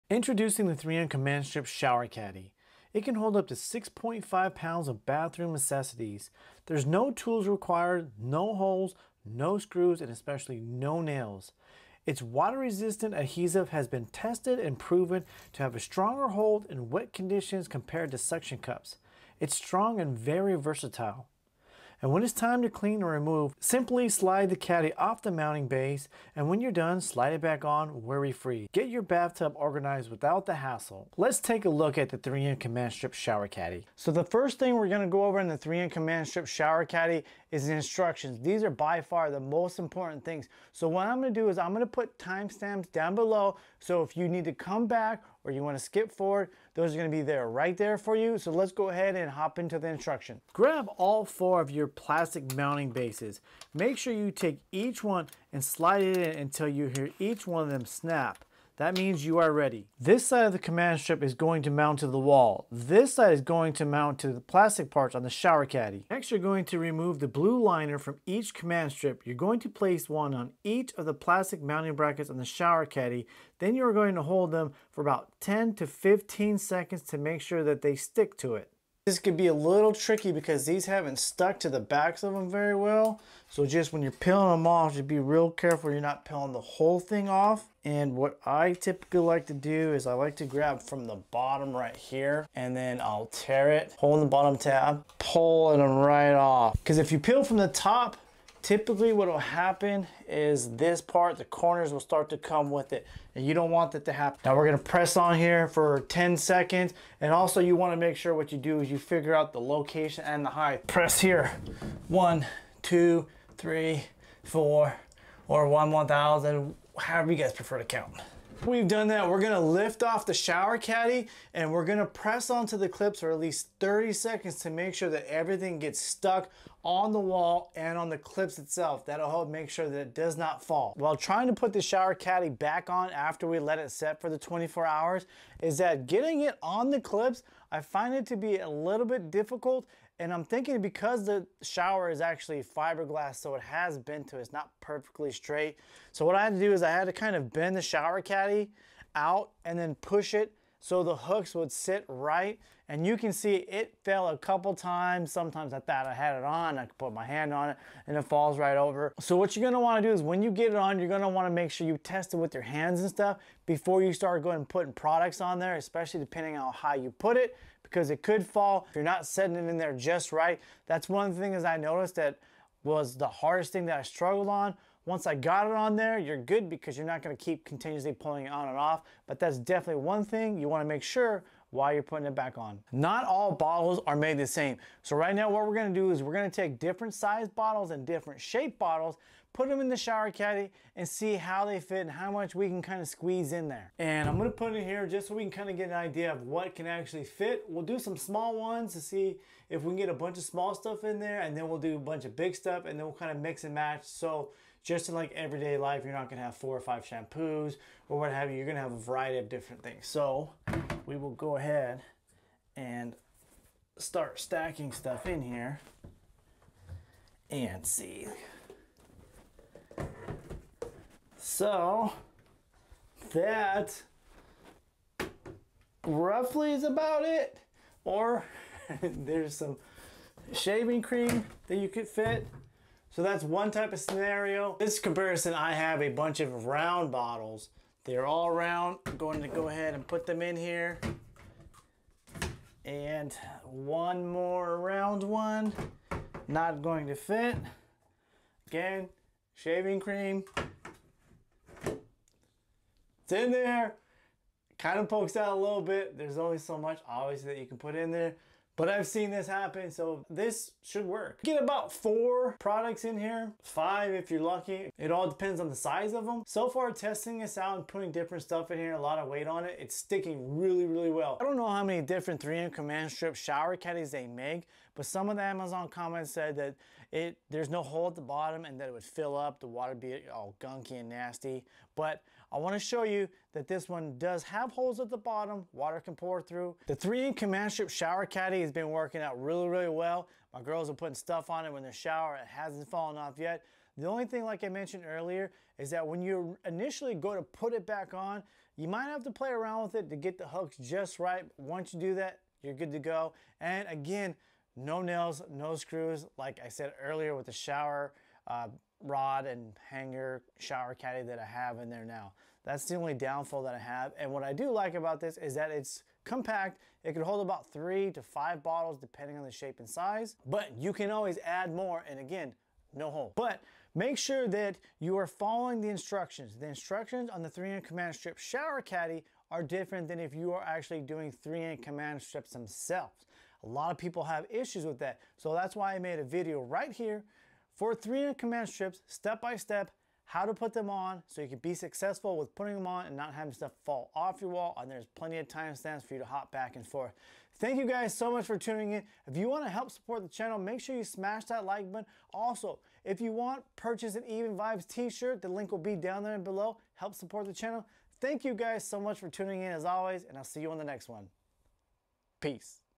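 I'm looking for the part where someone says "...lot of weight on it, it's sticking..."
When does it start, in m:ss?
4:28.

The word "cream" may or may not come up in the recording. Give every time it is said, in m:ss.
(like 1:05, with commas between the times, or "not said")
3:51, 4:09.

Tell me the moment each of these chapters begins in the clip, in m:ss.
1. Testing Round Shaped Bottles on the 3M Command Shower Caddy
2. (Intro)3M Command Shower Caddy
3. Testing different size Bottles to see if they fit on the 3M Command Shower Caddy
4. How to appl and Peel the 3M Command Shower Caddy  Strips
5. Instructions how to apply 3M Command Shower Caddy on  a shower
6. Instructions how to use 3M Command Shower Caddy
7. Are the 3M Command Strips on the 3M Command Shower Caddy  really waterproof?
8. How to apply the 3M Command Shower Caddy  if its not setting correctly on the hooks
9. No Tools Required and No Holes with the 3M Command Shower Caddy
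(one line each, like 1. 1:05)
1. 4:28
2. 0:34
3. 3:54
4. 1:39
5. 2:04
6. 0:57
7. 4:46
8. 3:00
9. 5:15.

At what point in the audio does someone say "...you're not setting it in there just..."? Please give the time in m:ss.
2:48.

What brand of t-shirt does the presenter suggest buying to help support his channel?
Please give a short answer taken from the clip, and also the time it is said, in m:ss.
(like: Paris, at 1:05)
Even Vibes, at 5:54.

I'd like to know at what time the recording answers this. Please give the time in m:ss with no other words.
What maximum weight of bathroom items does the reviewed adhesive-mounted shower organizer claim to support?
0:03.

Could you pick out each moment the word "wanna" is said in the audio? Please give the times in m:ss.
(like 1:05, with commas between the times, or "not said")
1:47, 3:00, 4:42.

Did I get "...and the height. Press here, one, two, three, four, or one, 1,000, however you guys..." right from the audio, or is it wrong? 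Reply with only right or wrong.
right.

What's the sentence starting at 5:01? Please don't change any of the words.
Once you do that, you're good to go.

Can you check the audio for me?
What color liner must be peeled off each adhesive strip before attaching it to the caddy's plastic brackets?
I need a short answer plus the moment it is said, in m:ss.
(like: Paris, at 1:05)
blue, at 1:07.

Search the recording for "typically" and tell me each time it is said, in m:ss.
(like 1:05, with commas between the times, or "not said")
1:28, 1:38.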